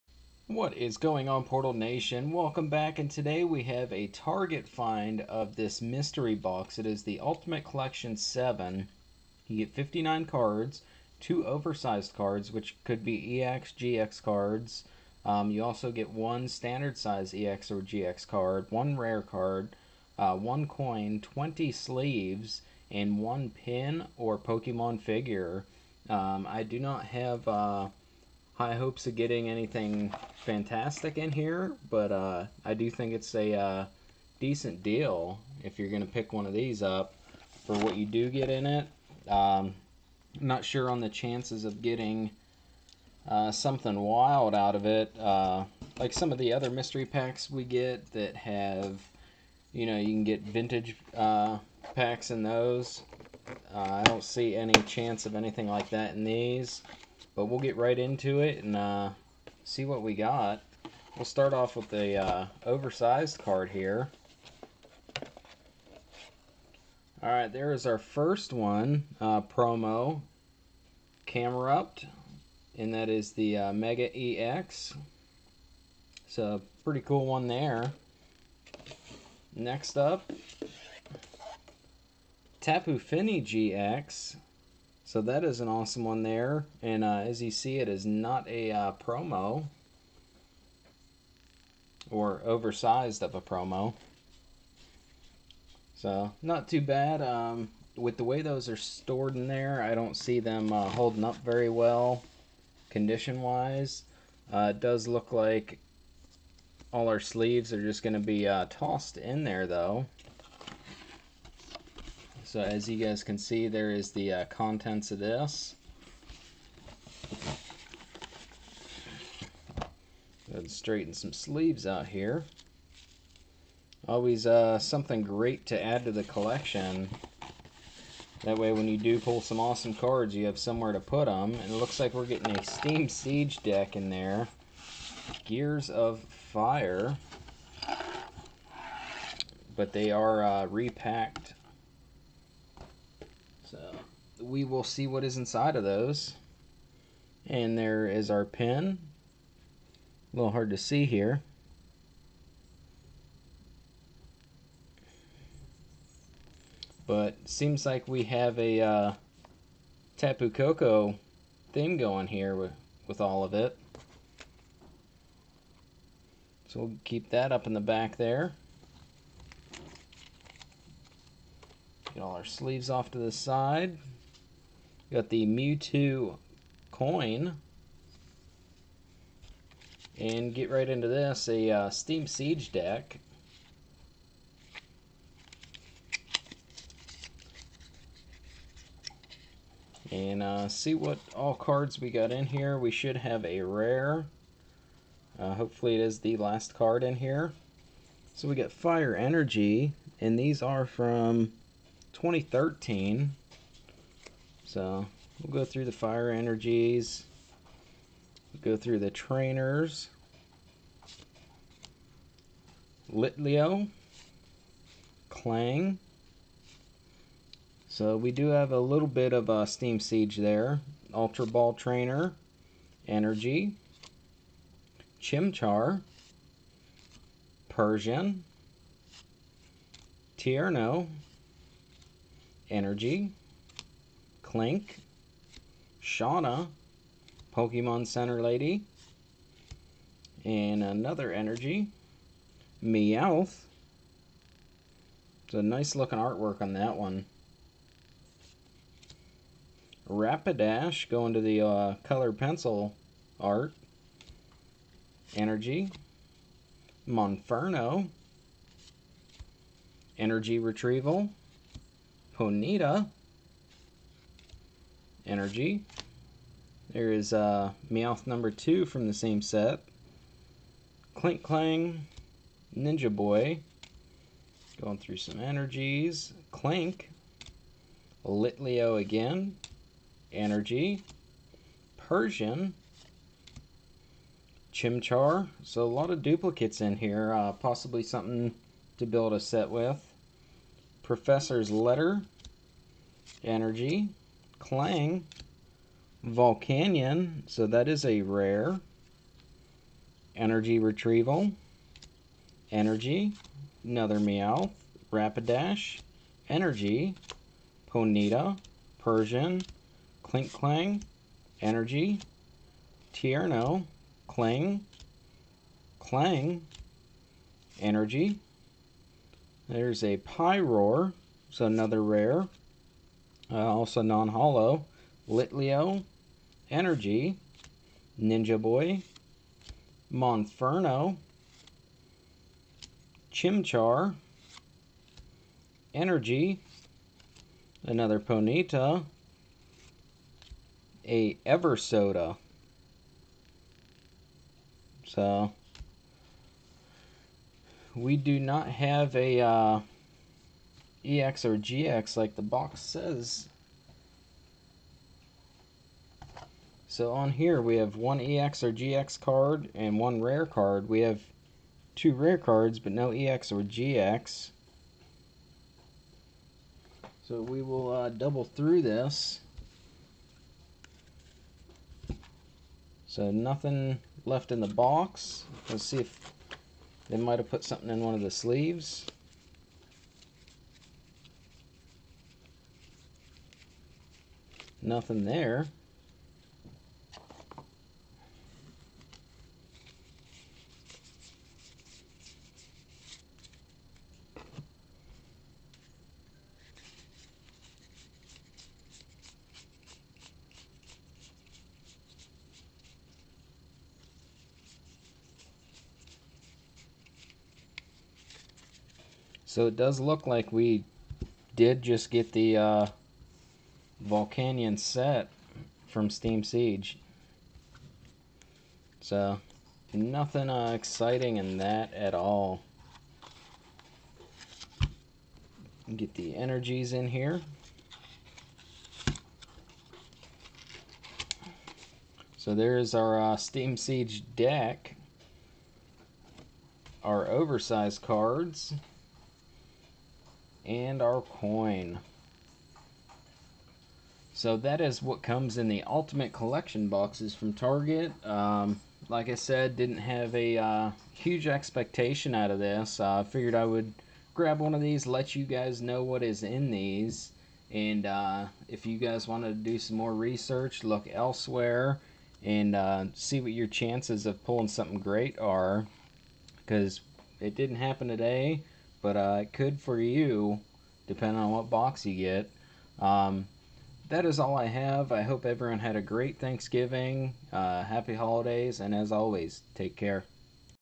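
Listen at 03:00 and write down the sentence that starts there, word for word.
And get right into this, a uh, Steam Siege deck.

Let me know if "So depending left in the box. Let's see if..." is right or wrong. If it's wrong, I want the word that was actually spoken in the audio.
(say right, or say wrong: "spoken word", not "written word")
wrong: "nothing", not "depending".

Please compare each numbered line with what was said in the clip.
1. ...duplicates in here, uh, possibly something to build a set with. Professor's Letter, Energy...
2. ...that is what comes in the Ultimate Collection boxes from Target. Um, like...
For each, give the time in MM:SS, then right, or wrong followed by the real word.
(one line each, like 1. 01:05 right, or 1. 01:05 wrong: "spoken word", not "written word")
1. 04:46 right
2. 07:24 right.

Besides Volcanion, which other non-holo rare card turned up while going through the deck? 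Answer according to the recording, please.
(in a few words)
Pyroar.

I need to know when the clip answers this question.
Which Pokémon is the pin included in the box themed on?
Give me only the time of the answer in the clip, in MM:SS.
02:40.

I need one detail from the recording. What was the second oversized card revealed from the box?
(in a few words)
Tapu Fini GX.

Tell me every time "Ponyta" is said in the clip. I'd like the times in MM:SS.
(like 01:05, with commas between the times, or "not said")
04:22, 05:07, 05:38.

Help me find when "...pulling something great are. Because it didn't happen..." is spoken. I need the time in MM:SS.
07:44.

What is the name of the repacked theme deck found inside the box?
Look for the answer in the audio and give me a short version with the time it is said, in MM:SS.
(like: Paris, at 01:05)
Gears of Fire, at 02:15.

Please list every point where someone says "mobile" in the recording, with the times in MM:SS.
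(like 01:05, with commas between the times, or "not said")
not said.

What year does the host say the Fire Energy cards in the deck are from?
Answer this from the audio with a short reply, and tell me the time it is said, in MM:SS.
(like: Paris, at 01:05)
2013, at 03:22.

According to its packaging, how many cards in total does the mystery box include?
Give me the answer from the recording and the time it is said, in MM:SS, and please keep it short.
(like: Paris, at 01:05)
59, at 00:09.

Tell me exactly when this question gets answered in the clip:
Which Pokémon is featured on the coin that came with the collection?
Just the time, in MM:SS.
02:55.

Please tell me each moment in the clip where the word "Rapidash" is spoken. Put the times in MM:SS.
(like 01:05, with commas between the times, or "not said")
04:10, 05:05.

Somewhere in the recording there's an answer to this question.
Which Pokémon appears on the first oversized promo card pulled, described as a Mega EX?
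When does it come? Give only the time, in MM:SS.
01:11.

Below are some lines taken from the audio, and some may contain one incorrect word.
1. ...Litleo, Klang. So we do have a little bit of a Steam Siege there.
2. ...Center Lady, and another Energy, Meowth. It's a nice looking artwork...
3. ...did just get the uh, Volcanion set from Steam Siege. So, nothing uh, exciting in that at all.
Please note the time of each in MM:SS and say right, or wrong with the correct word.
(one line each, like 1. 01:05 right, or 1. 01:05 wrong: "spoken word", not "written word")
1. 03:33 right
2. 03:58 right
3. 06:51 right.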